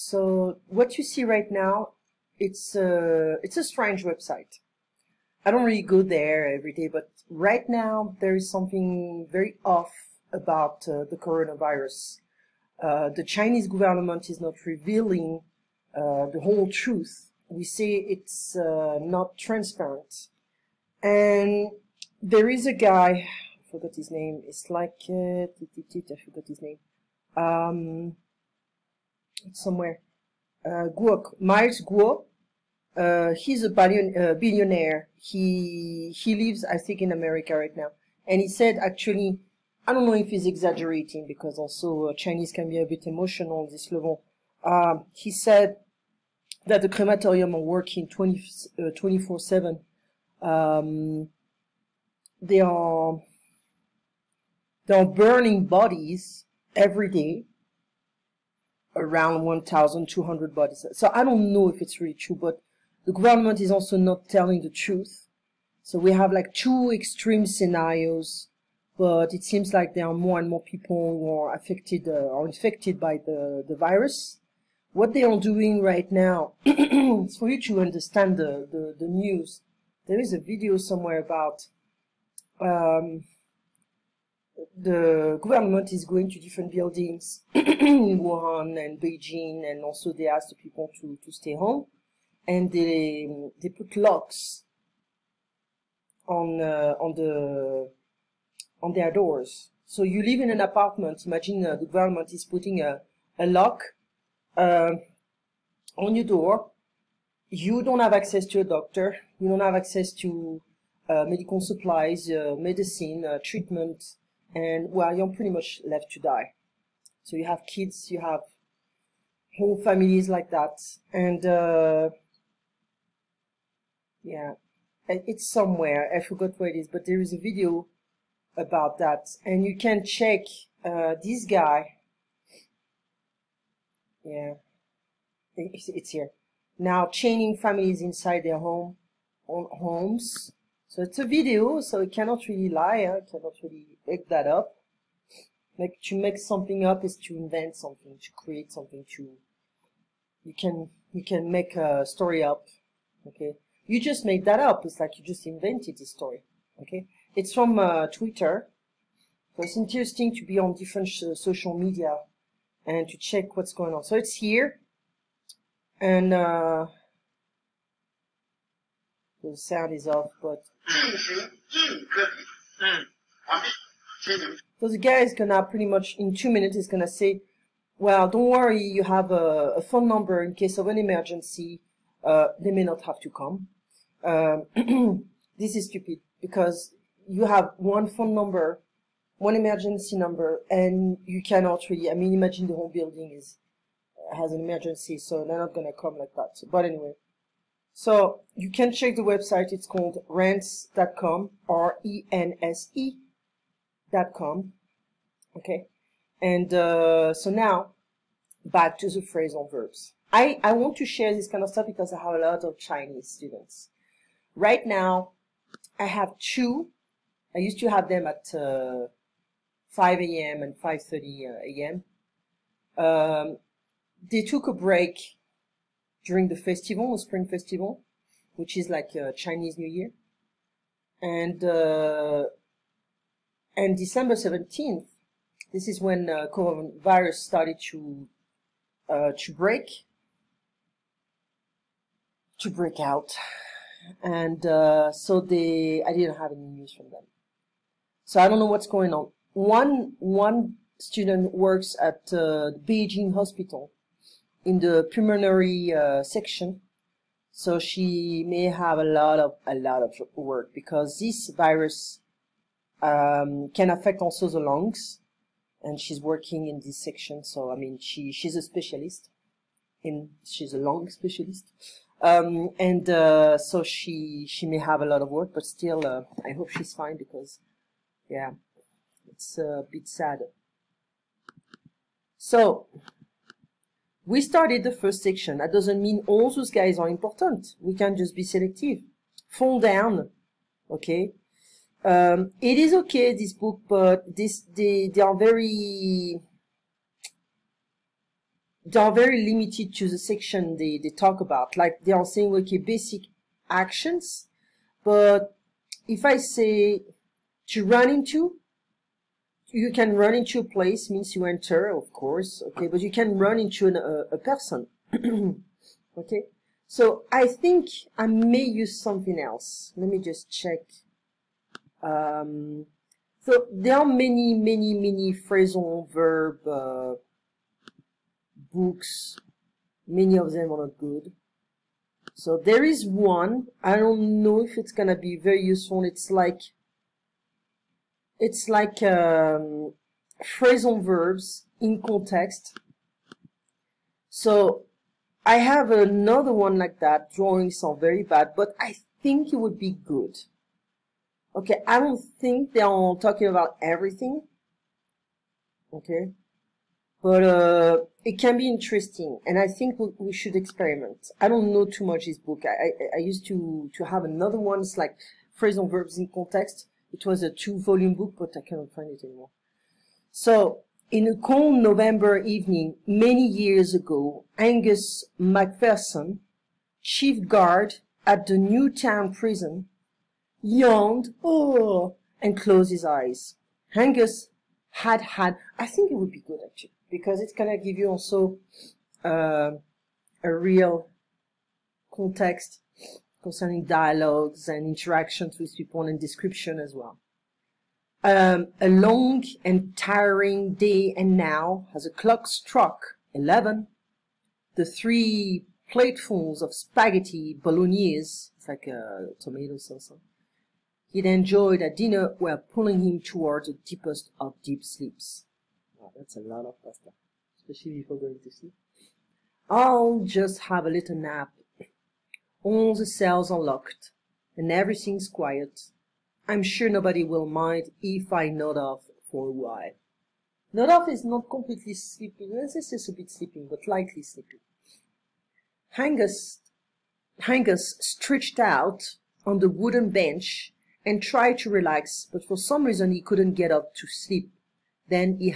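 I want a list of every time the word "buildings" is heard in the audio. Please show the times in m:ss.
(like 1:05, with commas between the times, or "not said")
1:26, 3:12.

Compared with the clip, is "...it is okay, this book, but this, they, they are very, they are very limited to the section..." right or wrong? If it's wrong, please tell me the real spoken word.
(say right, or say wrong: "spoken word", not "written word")
right.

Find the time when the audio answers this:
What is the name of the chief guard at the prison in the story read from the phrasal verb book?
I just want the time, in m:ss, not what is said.
6:14.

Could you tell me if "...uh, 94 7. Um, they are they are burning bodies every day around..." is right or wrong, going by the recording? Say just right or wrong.
wrong.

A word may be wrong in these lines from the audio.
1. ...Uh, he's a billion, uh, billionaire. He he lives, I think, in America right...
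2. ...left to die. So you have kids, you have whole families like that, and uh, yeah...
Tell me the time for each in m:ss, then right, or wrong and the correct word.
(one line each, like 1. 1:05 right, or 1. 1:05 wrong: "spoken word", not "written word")
1. 0:32 right
2. 1:55 right.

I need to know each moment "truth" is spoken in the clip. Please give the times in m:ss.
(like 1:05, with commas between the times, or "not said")
0:16, 1:04.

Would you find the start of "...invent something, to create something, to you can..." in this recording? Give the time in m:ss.
2:27.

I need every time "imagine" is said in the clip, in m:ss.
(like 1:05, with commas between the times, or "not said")
1:41, 3:12.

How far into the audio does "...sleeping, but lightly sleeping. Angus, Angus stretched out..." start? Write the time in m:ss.
7:13.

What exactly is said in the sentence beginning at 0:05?
I don't really go there every day, but right now there is something very off about uh, the coronavirus.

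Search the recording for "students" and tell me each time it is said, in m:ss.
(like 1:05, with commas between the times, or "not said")
3:33, 4:10.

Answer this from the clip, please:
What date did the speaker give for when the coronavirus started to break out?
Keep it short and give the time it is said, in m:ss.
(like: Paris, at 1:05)
December 17, at 3:53.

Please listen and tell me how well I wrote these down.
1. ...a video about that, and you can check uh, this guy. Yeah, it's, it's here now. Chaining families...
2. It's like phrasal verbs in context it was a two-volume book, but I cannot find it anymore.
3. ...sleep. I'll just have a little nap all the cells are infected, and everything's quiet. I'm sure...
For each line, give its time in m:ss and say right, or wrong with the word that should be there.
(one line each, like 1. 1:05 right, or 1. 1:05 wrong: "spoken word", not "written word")
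1. 2:07 right
2. 6:04 right
3. 6:58 wrong: "locked", not "infected".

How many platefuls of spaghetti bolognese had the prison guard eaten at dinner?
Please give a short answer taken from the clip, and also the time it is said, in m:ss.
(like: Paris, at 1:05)
3, at 6:44.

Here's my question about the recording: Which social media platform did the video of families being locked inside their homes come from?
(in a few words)
Twitter.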